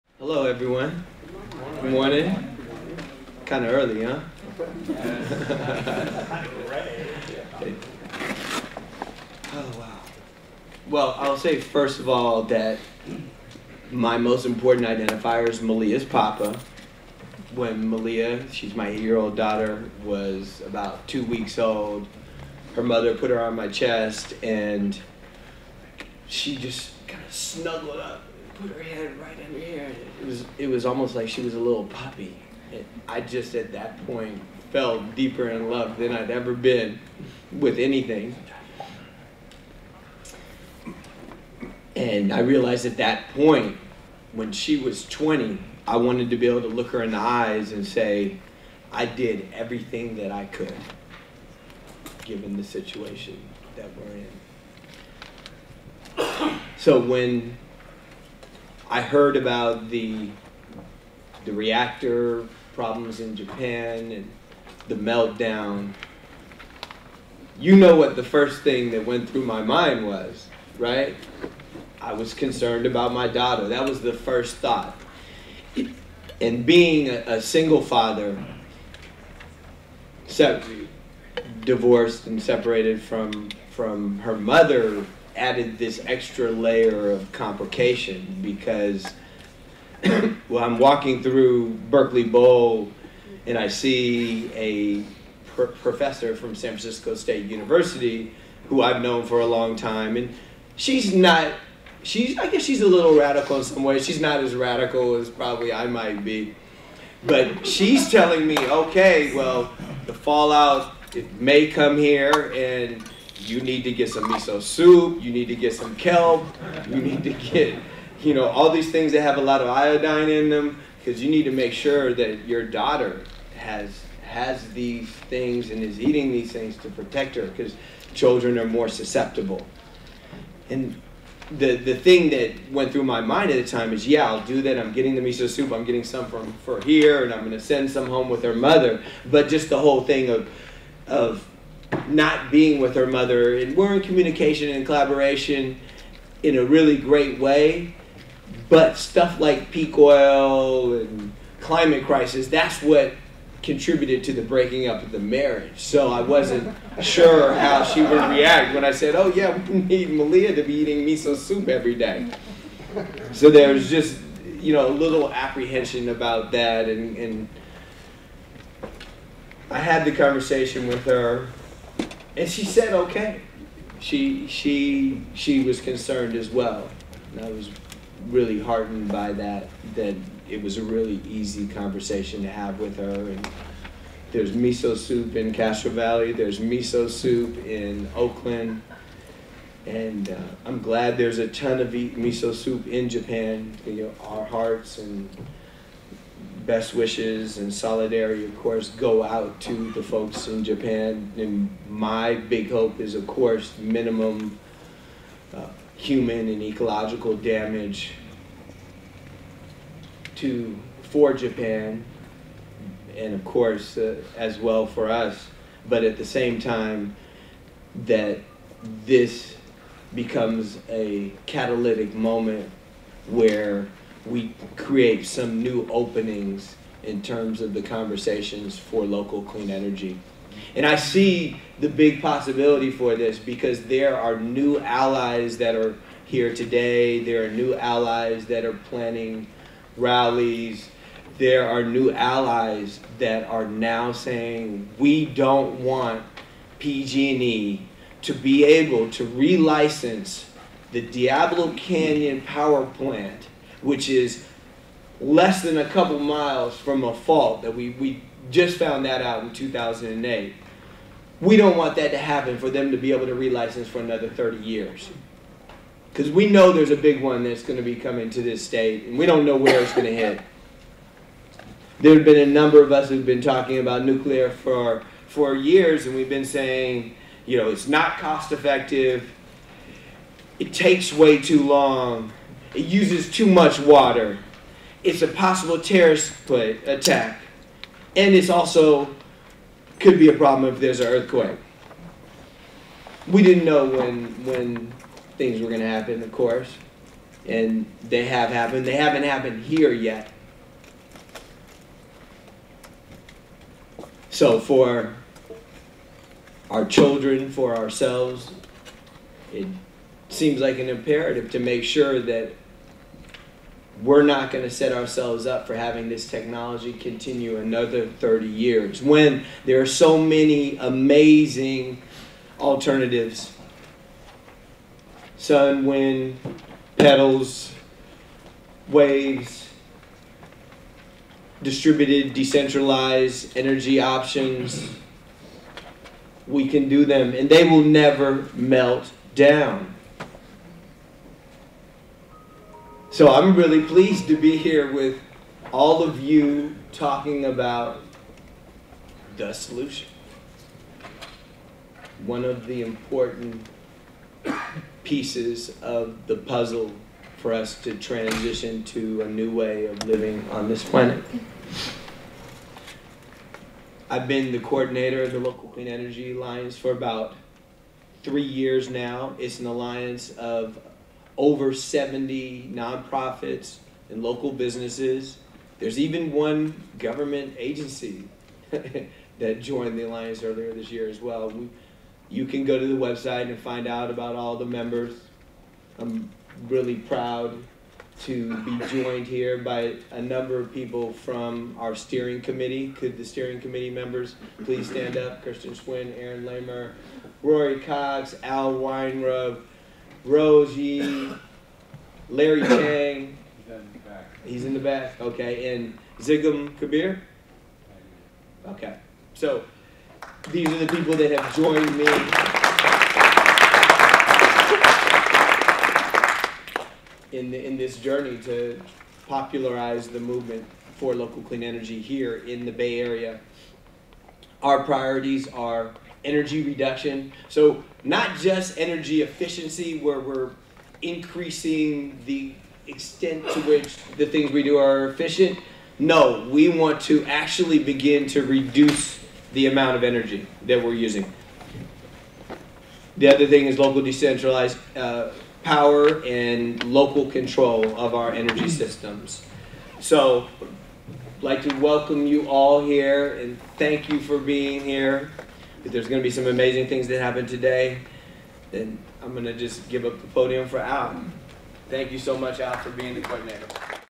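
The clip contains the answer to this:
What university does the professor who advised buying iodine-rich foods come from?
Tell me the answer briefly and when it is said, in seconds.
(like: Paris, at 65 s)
San Francisco State University, at 96 s.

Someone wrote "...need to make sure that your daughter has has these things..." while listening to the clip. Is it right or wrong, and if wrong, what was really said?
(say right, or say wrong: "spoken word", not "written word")
right.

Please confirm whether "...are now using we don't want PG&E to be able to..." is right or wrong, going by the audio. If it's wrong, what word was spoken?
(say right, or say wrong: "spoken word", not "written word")
wrong: "saying", not "using".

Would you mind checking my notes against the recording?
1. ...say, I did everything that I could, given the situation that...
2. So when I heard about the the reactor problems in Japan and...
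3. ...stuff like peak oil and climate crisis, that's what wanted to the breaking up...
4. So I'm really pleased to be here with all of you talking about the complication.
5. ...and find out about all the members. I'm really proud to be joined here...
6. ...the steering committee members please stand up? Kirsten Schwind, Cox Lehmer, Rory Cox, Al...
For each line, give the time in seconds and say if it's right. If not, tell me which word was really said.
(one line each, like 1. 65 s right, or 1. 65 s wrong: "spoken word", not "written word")
1. 47 s right
2. 56 s right
3. 148 s wrong: "contributed", not "wanted"
4. 343 s wrong: "solution", not "complication"
5. 383 s right
6. 393 s wrong: "Aaron", not "Cox".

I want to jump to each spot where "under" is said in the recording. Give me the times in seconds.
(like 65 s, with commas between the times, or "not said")
29 s.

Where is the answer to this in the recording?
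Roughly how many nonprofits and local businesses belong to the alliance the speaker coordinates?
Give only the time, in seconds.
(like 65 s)
371 s.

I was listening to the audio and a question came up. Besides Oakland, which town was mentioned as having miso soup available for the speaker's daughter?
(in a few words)
Castro Valley.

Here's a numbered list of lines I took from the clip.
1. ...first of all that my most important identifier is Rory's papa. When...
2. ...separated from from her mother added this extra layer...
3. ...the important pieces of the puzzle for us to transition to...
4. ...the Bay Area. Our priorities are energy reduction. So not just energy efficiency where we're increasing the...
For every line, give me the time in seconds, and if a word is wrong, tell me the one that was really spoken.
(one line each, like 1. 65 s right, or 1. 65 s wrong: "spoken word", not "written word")
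1. 11 s wrong: "Malia", not "Rory"
2. 82 s right
3. 352 s right
4. 422 s right.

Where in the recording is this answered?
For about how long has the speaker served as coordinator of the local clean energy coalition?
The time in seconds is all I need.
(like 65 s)
368 s.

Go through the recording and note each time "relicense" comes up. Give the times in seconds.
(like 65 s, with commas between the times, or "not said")
249 s, 263 s.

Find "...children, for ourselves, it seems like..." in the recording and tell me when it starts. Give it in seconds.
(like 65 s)
306 s.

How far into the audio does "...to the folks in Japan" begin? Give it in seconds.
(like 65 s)
199 s.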